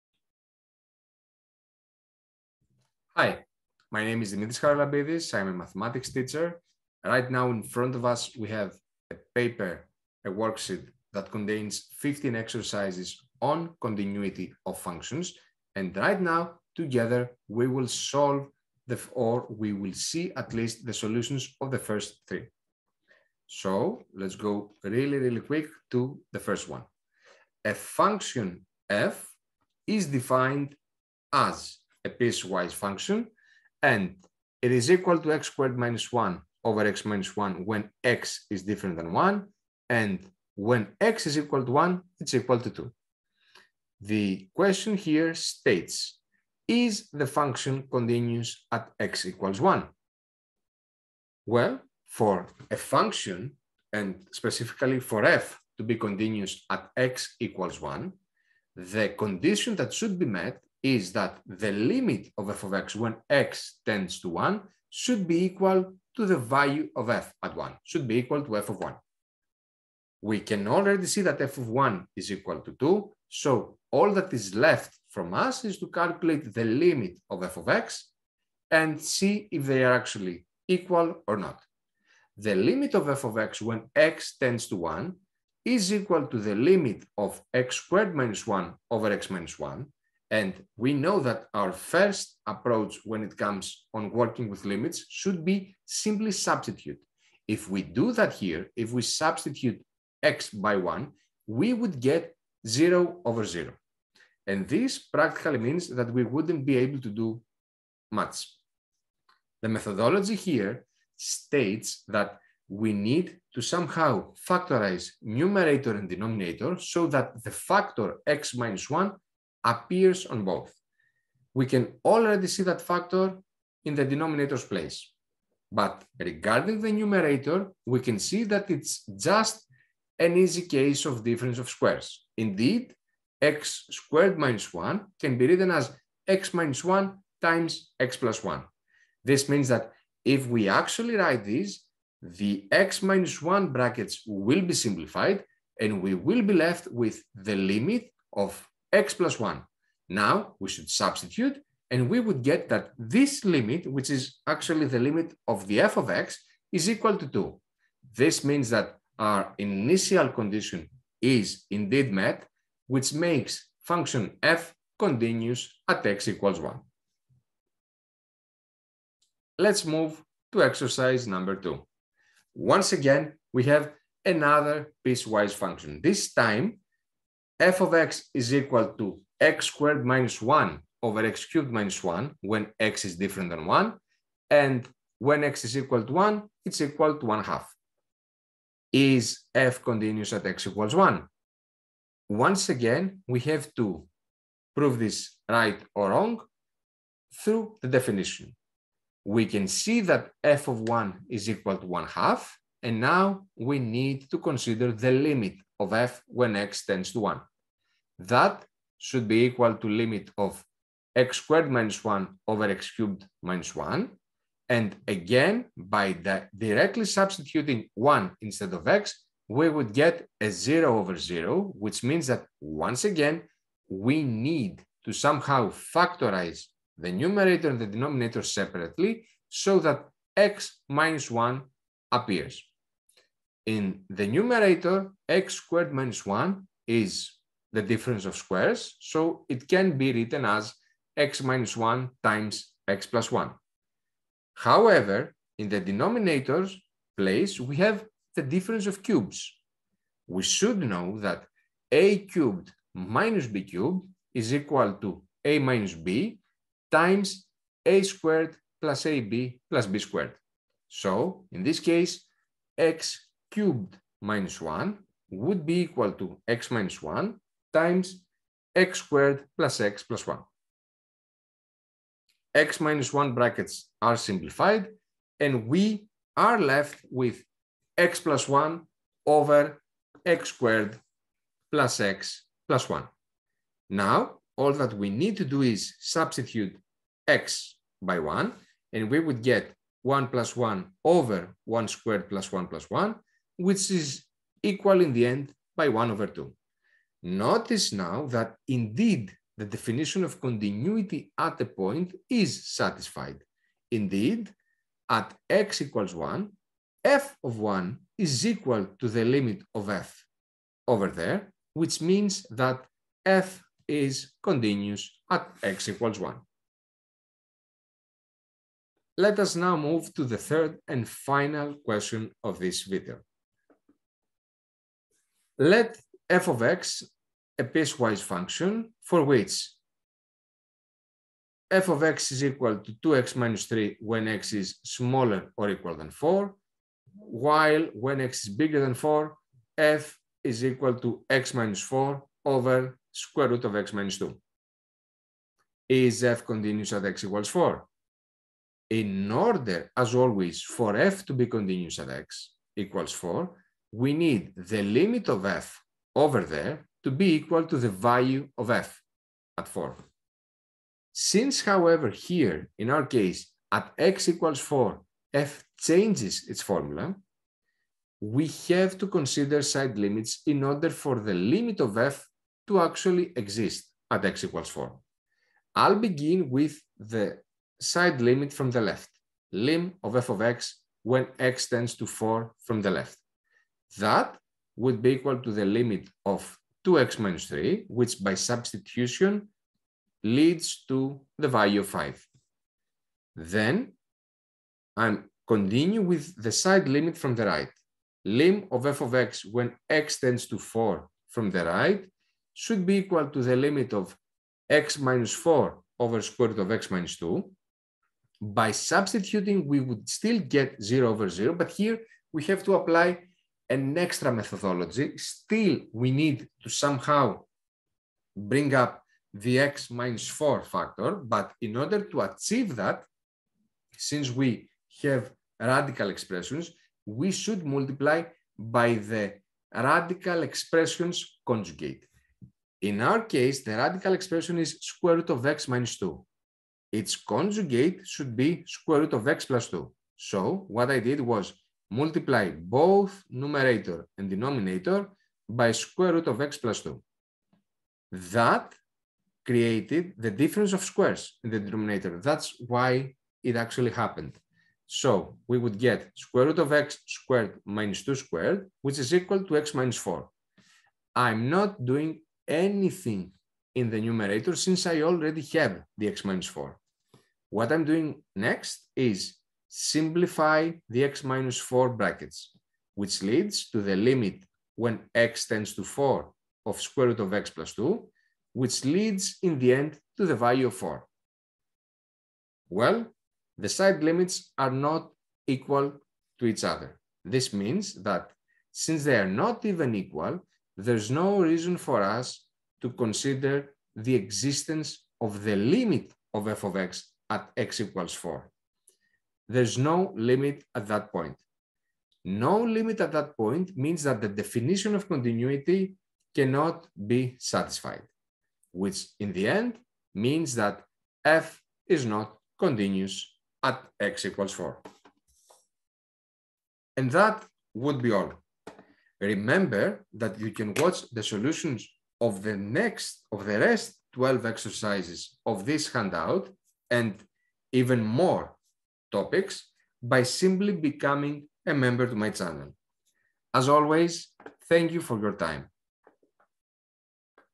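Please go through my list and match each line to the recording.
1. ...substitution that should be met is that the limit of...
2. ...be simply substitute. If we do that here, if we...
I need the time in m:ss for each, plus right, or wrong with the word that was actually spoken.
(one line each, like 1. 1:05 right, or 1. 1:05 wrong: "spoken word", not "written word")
1. 0:59 wrong: "condition", not "substitution"
2. 1:35 right.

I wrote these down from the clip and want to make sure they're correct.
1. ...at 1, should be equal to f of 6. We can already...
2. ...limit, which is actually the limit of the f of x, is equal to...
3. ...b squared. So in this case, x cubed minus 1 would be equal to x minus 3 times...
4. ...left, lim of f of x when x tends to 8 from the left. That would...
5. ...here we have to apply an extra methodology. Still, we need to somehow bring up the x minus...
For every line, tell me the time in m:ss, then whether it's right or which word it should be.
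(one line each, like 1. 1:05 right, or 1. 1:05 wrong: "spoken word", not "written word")
1. 1:07 wrong: "1", not "6"
2. 2:33 right
3. 4:19 wrong: "1", not "3"
4. 6:18 wrong: "4", not "8"
5. 6:51 right.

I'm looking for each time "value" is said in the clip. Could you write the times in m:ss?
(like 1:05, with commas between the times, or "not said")
1:06, 5:57, 6:31, 8:00.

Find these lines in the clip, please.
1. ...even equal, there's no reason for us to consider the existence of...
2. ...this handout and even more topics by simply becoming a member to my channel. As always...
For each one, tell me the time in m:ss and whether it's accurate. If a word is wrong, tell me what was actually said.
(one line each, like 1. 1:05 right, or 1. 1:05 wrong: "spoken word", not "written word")
1. 8:09 right
2. 8:45 right.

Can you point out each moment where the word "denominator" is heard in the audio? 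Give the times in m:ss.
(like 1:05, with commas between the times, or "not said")
1:56, 2:04, 3:47, 4:05, 7:24, 7:31.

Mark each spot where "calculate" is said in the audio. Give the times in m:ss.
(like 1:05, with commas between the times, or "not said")
1:15.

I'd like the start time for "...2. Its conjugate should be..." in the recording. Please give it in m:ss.
7:15.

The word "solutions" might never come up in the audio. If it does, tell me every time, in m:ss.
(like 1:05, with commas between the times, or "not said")
0:20, 8:41.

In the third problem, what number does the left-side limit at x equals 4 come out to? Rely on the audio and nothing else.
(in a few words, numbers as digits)
5.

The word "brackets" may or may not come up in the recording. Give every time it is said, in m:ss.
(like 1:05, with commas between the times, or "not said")
2:23, 4:33, 7:51.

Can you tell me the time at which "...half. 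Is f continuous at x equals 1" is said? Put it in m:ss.
3:07.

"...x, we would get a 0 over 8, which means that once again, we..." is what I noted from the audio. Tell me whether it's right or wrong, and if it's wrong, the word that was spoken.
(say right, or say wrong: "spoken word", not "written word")
wrong: "0", not "8".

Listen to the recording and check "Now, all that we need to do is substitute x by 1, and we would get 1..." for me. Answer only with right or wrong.
right.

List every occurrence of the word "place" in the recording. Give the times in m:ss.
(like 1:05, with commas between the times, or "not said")
2:04, 4:07.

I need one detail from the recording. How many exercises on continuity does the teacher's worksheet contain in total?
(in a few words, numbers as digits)
15.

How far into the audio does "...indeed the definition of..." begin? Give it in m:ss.
4:58.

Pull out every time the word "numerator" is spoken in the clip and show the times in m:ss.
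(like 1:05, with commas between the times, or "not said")
1:55, 2:06, 3:47, 3:54, 7:23, 7:43.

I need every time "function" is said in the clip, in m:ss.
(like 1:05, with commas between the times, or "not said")
0:14, 0:27, 0:32, 0:47, 0:52, 2:43, 2:55, 5:28.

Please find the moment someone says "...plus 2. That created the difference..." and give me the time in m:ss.
7:26.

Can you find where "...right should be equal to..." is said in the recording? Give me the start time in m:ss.
6:41.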